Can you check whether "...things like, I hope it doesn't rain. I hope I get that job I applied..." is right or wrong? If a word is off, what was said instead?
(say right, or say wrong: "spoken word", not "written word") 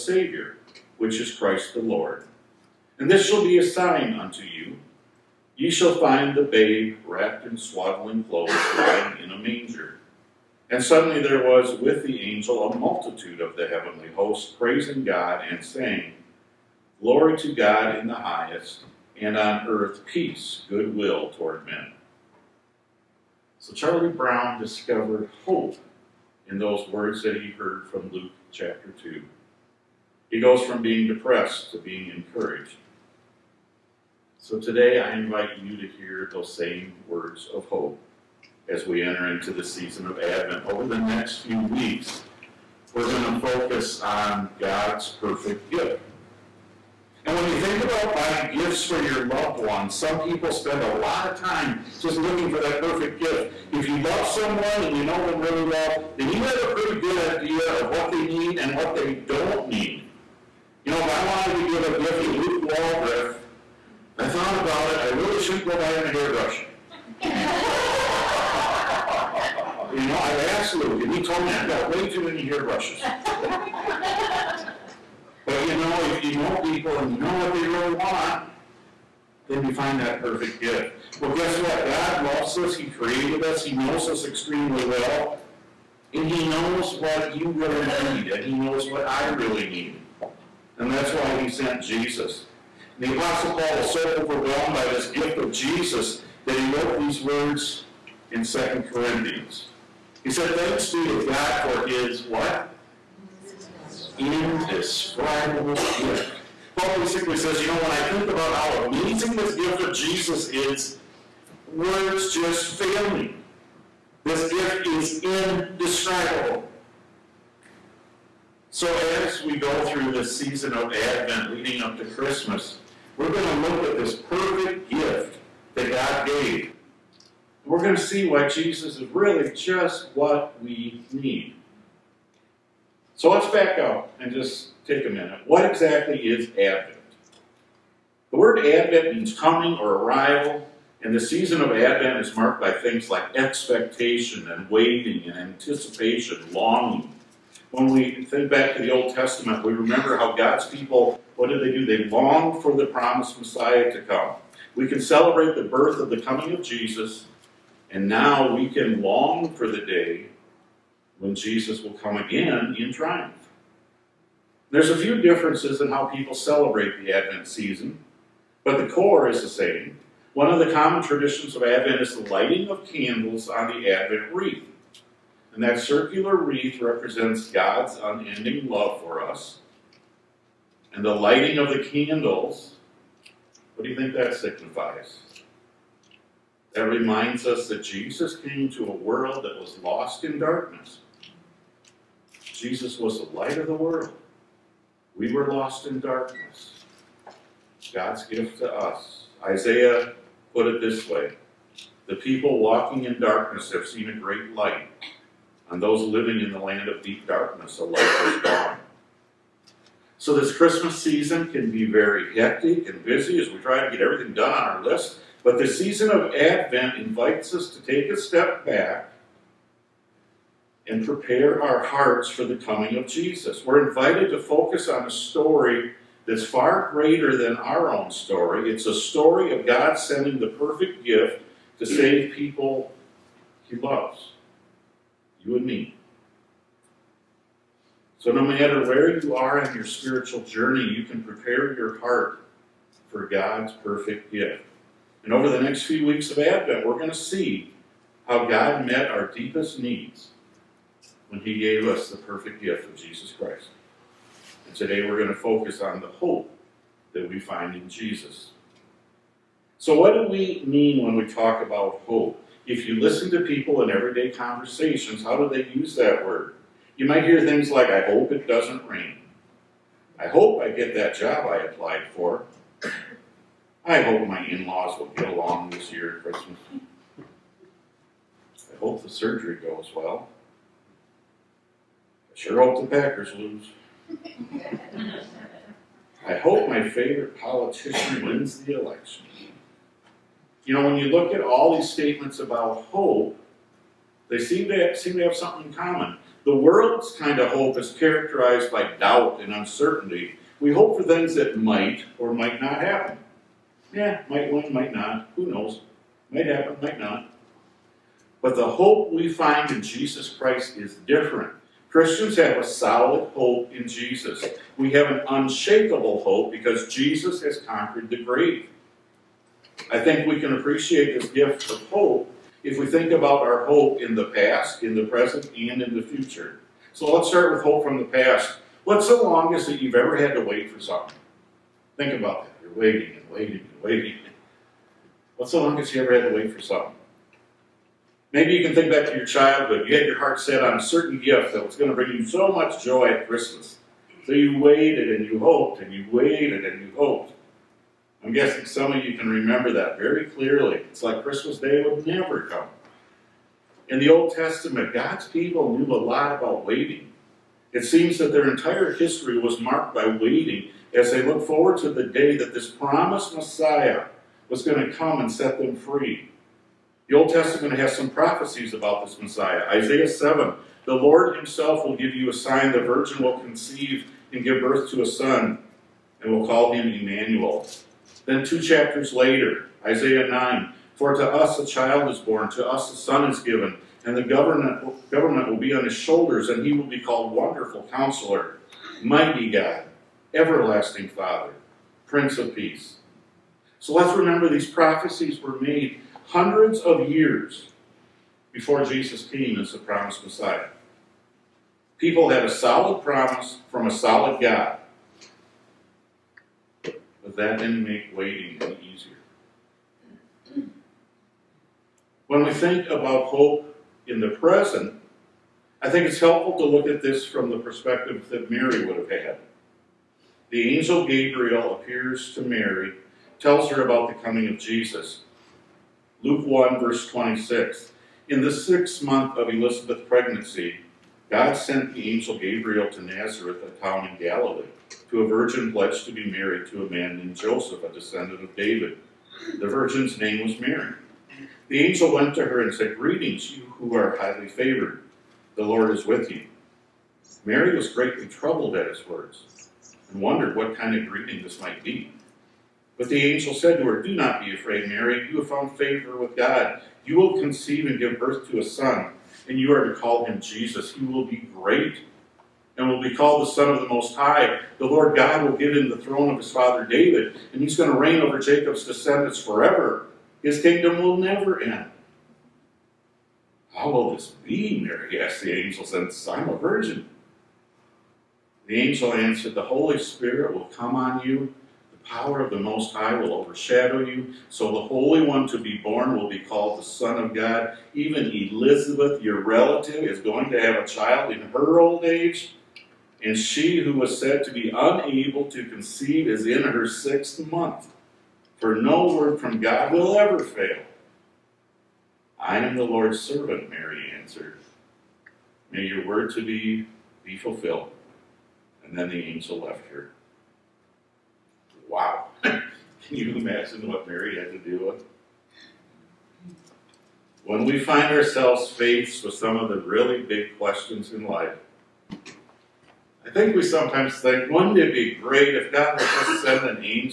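right.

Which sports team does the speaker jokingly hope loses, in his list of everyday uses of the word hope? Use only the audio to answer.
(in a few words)
Packers.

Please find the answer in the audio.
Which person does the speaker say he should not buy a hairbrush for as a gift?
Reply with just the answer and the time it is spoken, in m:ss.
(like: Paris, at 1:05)
Luke Waldriff, at 1:02.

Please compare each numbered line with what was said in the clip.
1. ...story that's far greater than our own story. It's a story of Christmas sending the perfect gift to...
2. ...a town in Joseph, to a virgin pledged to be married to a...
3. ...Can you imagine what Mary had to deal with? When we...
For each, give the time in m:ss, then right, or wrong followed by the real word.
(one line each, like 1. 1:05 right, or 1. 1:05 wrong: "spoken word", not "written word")
1. 3:45 wrong: "God", not "Christmas"
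2. 7:13 wrong: "Galilee", not "Joseph"
3. 8:32 right.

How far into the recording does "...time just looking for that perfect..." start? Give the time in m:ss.
0:51.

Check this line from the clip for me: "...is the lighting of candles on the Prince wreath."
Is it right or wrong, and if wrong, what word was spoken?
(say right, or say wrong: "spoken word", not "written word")
wrong: "Advent", not "Prince".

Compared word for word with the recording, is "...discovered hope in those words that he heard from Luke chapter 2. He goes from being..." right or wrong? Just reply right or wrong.
right.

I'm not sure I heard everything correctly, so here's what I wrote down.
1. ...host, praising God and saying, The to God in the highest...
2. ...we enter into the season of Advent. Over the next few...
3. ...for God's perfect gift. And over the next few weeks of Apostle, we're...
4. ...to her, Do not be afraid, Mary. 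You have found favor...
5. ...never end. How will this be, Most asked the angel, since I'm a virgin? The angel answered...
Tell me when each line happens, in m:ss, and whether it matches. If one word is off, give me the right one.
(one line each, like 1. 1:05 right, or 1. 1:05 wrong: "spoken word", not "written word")
1. 0:14 wrong: "Glory", not "The"
2. 0:38 right
3. 4:03 wrong: "Advent", not "Apostle"
4. 7:33 right
5. 7:51 wrong: "Mary", not "Most".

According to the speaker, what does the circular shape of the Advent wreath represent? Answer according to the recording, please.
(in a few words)
God's unending love.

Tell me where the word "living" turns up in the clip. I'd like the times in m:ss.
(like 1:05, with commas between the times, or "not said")
3:26.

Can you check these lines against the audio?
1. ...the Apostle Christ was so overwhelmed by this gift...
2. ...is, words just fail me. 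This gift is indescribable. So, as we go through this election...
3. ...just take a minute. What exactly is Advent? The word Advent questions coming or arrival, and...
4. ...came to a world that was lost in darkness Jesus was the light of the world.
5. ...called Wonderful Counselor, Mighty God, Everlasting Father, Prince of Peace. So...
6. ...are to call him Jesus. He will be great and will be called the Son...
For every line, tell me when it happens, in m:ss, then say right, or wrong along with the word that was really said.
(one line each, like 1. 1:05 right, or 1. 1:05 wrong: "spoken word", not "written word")
1. 1:33 wrong: "Paul", not "Christ"
2. 1:50 wrong: "season", not "election"
3. 2:14 wrong: "means", not "questions"
4. 3:08 right
5. 6:26 right
6. 7:39 right.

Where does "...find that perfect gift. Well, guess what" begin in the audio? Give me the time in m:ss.
1:19.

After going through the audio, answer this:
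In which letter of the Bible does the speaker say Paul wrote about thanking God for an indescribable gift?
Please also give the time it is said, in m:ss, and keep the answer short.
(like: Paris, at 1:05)
Second Corinthians, at 1:38.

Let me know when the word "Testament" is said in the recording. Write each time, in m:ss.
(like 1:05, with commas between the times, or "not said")
2:29, 5:54, 6:07.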